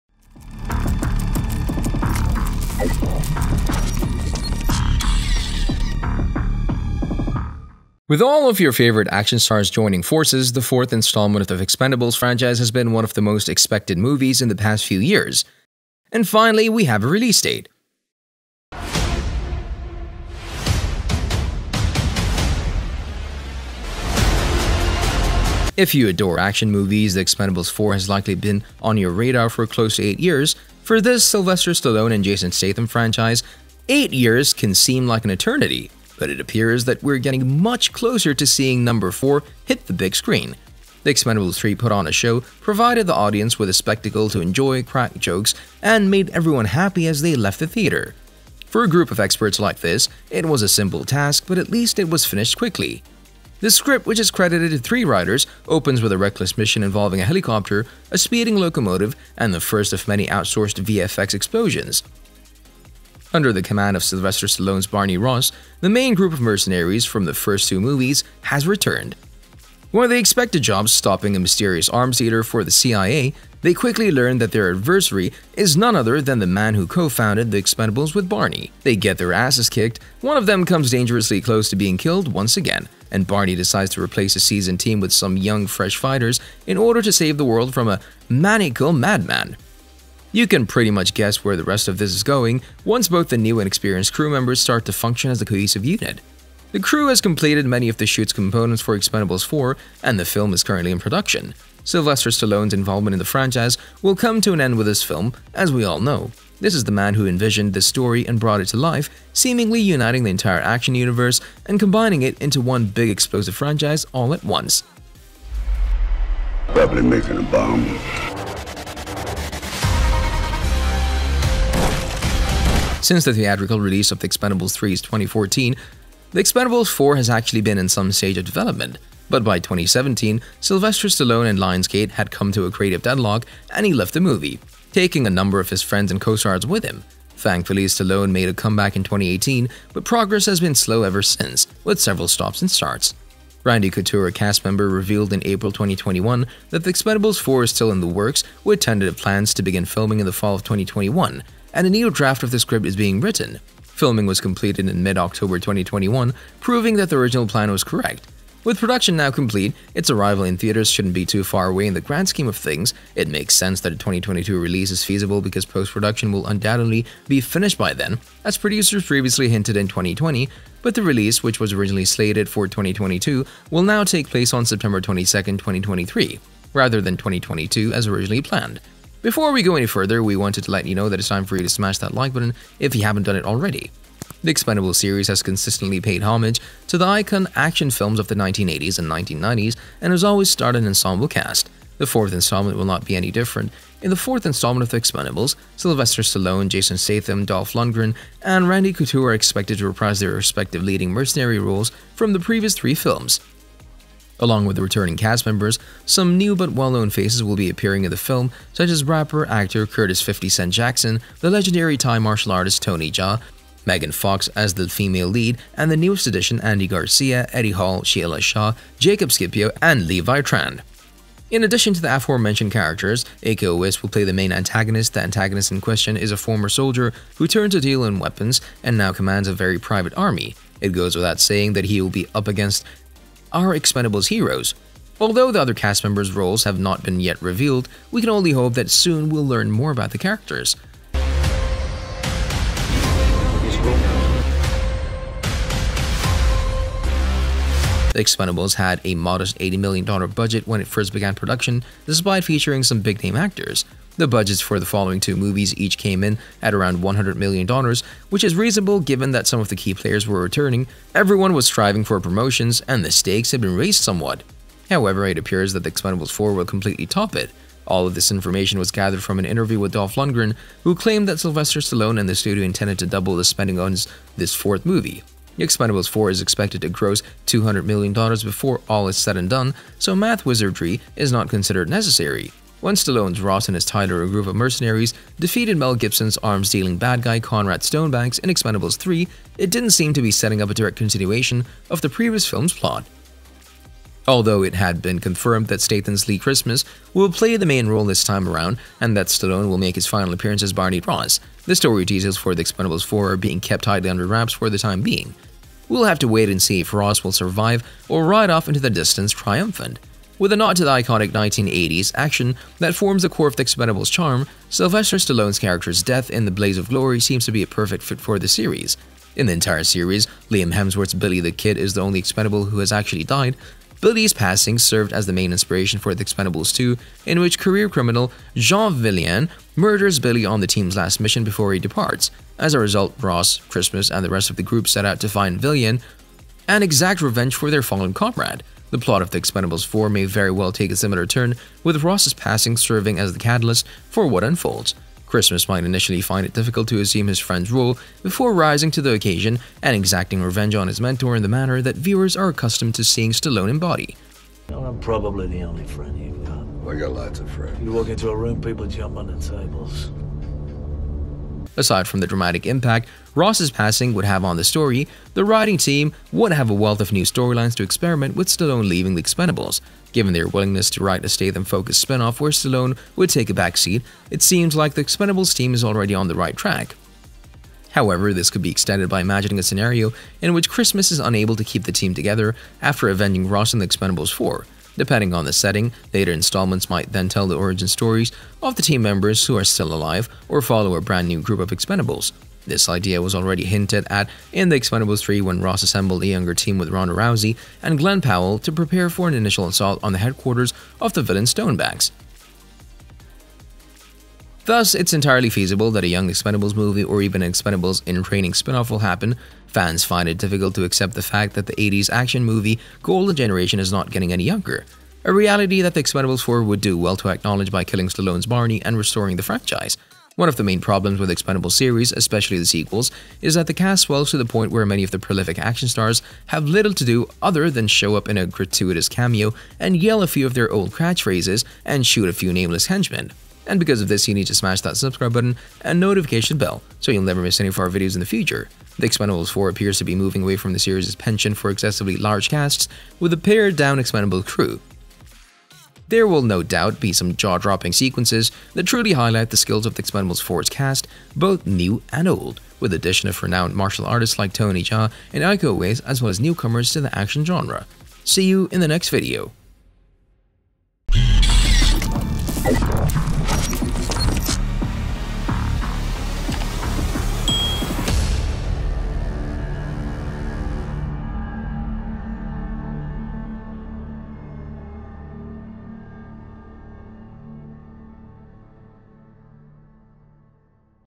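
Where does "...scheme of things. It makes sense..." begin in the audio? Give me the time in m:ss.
2:42.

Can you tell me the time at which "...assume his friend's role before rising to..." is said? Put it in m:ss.
5:46.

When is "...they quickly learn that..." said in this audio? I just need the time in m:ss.
1:13.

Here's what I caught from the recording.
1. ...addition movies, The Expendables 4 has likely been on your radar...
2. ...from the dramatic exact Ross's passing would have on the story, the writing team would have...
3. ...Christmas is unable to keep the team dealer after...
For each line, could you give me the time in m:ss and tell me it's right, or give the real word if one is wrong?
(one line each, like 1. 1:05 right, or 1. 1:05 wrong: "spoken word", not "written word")
1. 0:26 wrong: "action", not "addition"
2. 6:02 wrong: "impact", not "exact"
3. 6:20 wrong: "together", not "dealer".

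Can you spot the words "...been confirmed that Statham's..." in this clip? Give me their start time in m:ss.
4:54.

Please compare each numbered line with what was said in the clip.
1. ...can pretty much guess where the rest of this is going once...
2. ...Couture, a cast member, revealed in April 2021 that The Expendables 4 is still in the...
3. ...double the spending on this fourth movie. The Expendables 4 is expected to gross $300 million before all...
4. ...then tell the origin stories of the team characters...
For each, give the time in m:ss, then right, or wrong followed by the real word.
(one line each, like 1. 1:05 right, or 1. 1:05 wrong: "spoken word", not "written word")
1. 1:30 right
2. 2:23 right
3. 4:33 wrong: "200", not "300"
4. 6:27 wrong: "members", not "characters".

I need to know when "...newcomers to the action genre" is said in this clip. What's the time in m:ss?
7:36.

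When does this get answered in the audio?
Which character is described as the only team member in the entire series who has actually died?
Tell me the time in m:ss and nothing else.
5:21.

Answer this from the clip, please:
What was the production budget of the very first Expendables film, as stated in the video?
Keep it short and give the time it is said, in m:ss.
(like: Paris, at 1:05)
$80 million, at 4:09.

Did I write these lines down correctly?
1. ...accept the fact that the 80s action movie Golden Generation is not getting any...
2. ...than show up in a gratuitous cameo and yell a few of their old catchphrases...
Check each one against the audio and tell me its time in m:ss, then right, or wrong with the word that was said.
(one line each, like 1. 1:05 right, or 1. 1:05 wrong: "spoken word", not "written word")
1. 6:50 right
2. 7:07 right.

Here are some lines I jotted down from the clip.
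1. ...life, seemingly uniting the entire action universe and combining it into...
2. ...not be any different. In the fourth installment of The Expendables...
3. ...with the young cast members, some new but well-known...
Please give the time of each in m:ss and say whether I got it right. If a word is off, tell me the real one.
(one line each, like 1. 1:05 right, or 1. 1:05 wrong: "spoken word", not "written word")
1. 1:48 right
2. 3:12 right
3. 3:24 wrong: "returning", not "young".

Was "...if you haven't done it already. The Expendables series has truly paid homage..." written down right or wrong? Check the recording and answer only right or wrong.
wrong.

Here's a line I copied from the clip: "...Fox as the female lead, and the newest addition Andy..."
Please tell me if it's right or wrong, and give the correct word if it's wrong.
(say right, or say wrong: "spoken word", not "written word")
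right.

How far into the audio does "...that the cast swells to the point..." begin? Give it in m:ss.
7:03.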